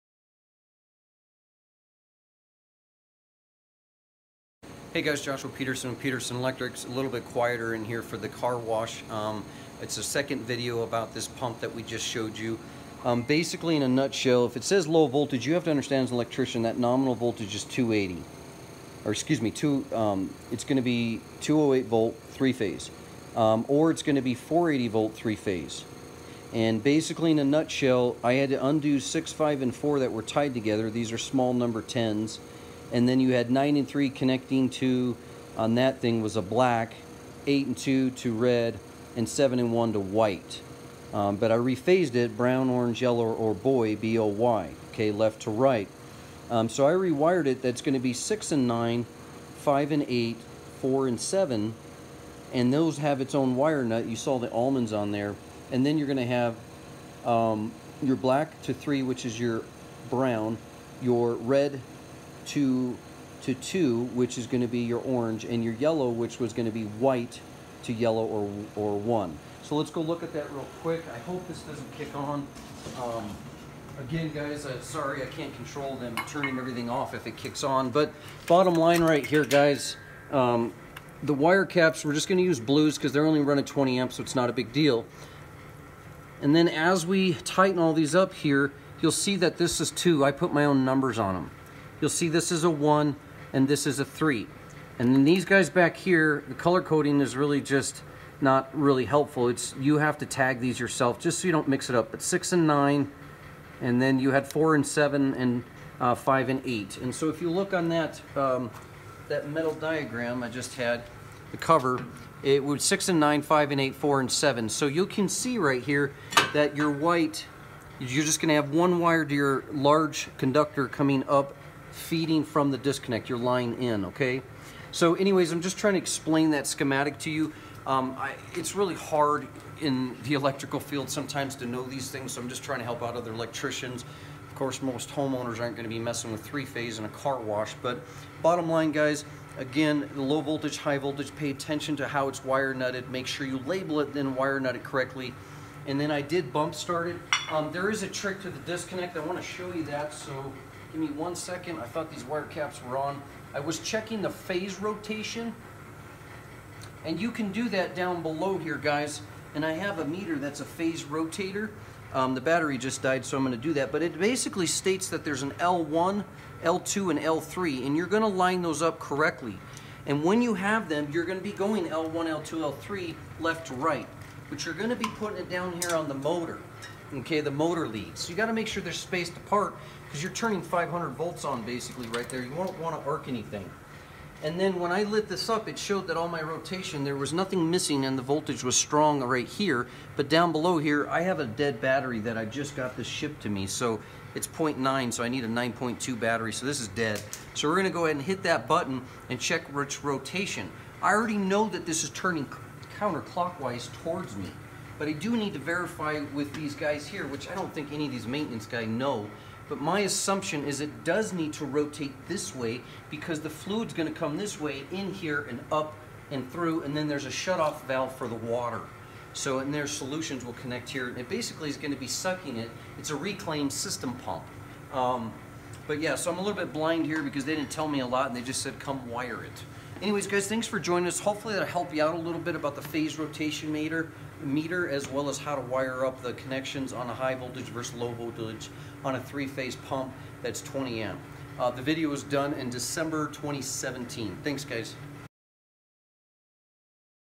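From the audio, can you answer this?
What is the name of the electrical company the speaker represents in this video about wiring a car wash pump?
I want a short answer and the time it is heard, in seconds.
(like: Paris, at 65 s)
Peterson Electrics, at 6 s.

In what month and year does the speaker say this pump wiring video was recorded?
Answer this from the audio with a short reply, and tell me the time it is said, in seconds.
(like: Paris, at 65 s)
December 2017, at 242 s.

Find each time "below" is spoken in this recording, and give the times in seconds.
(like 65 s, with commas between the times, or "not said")
158 s, 190 s.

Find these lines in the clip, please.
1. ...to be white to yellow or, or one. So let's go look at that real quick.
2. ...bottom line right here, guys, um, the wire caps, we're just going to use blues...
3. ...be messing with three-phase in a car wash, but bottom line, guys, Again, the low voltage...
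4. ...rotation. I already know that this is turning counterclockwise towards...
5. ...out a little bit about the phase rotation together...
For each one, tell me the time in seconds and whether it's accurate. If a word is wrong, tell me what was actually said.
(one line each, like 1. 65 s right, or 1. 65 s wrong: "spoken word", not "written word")
1. 66 s right
2. 78 s right
3. 135 s right
4. 200 s right
5. 232 s wrong: "meter", not "together".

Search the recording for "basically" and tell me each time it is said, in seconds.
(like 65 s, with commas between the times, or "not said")
13 s, 26 s, 164 s, 181 s, 221 s.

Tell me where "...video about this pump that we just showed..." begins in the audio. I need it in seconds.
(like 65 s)
10 s.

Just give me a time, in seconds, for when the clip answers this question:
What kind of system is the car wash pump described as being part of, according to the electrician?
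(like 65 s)
223 s.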